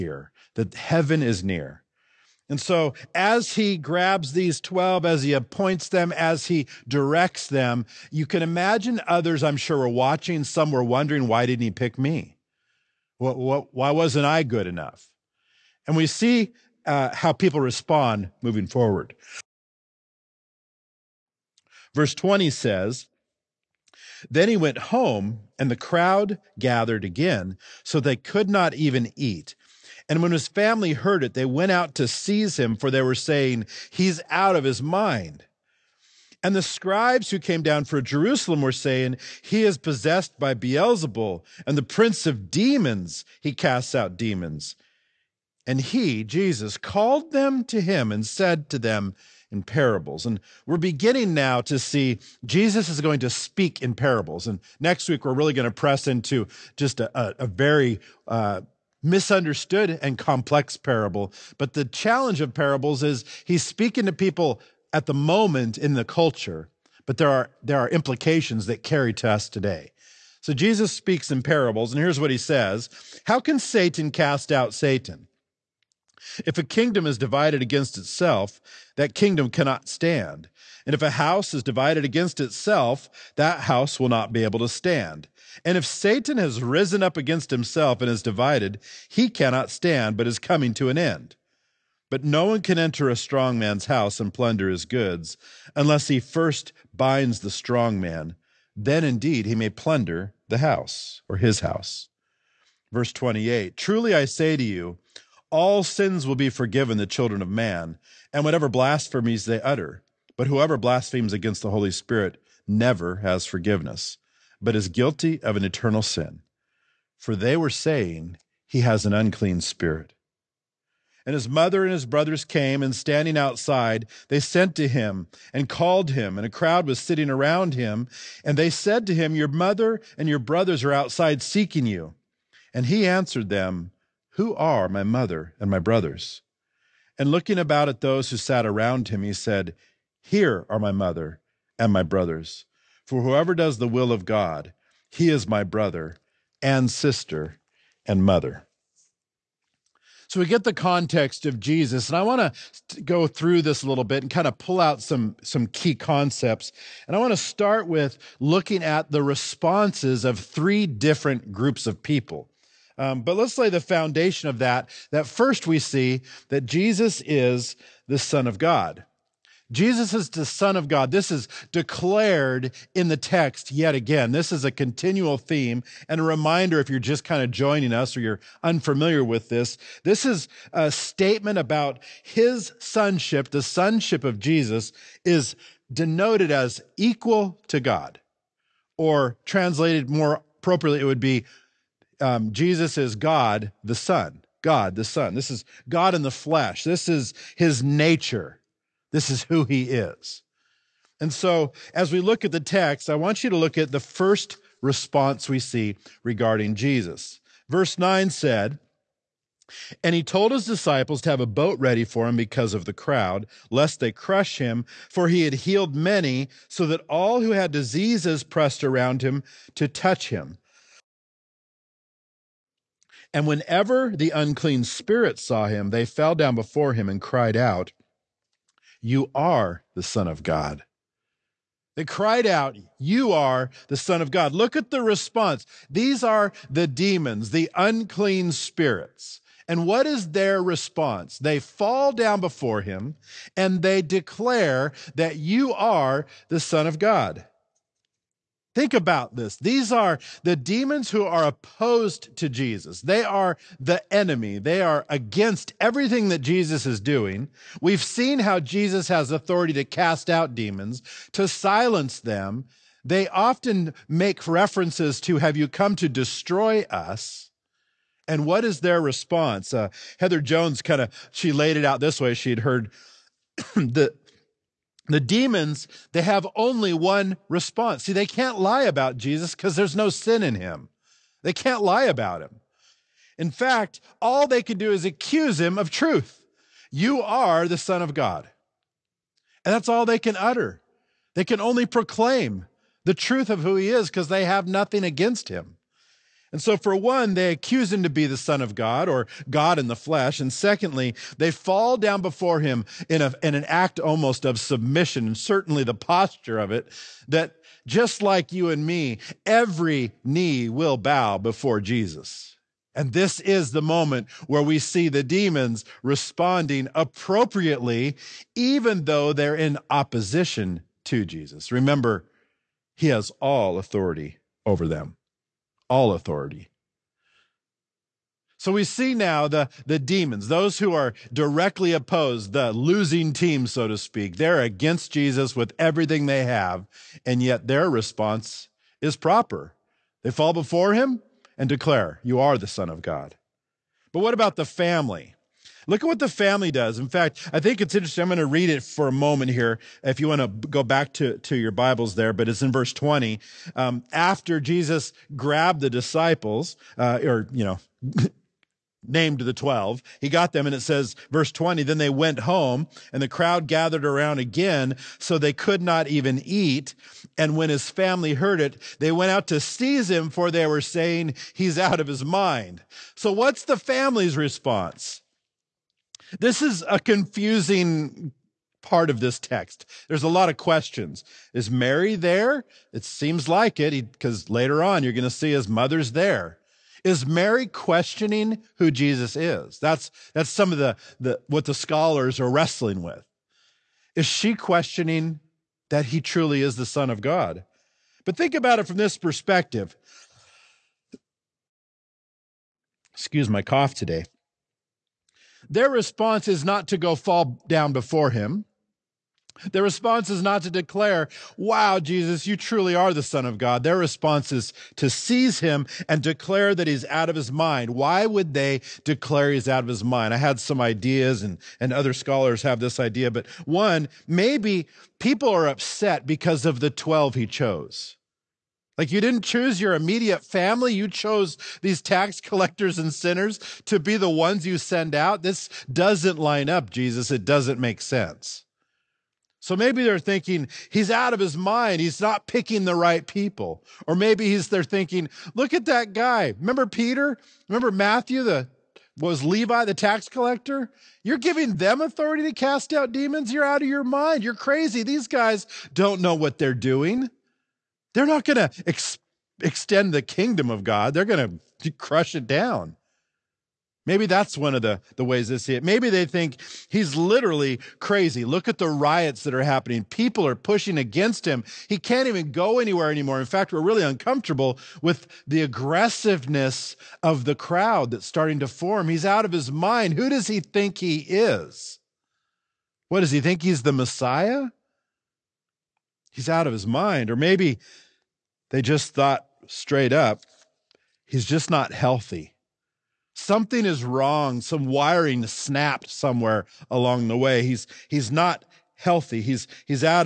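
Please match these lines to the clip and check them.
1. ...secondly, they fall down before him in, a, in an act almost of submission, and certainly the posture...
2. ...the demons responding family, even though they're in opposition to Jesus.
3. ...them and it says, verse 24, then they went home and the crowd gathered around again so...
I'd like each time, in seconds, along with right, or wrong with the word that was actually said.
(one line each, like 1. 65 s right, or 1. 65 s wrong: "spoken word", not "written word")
1. 300 s right
2. 315 s wrong: "appropriately", not "family"
3. 360 s wrong: "20", not "24".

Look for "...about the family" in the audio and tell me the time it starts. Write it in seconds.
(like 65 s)
344 s.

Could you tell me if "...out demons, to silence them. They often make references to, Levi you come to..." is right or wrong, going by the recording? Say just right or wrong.
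wrong.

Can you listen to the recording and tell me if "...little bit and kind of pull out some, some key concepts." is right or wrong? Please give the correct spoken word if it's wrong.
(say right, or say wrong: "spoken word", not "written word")
right.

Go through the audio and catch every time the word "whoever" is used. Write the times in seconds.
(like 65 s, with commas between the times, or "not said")
110 s, 143 s.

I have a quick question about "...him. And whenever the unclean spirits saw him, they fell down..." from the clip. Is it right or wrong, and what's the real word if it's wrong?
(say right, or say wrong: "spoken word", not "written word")
right.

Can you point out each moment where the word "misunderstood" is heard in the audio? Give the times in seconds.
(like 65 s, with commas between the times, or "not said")
59 s.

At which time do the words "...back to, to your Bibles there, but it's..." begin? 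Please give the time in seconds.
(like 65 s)
350 s.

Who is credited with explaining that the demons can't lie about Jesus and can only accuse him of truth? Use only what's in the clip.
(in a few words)
Heather Jones.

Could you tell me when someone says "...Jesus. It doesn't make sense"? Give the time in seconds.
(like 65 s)
436 s.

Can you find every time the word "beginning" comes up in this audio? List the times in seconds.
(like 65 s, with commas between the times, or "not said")
50 s.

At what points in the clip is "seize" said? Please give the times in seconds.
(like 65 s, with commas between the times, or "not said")
32 s, 369 s, 415 s.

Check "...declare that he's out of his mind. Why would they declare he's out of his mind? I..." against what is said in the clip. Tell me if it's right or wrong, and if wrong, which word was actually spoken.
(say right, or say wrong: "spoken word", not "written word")
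right.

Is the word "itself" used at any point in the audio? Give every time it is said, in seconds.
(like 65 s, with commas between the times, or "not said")
77 s, 82 s.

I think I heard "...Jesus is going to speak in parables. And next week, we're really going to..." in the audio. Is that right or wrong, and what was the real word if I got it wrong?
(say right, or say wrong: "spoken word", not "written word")
right.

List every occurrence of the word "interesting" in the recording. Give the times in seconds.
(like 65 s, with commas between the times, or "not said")
347 s.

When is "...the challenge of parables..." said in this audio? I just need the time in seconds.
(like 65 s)
61 s.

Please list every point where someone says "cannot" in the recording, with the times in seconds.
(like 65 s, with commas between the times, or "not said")
79 s, 89 s.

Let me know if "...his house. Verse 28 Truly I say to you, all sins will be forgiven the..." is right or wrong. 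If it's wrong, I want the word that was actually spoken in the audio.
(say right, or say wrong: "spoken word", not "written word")
right.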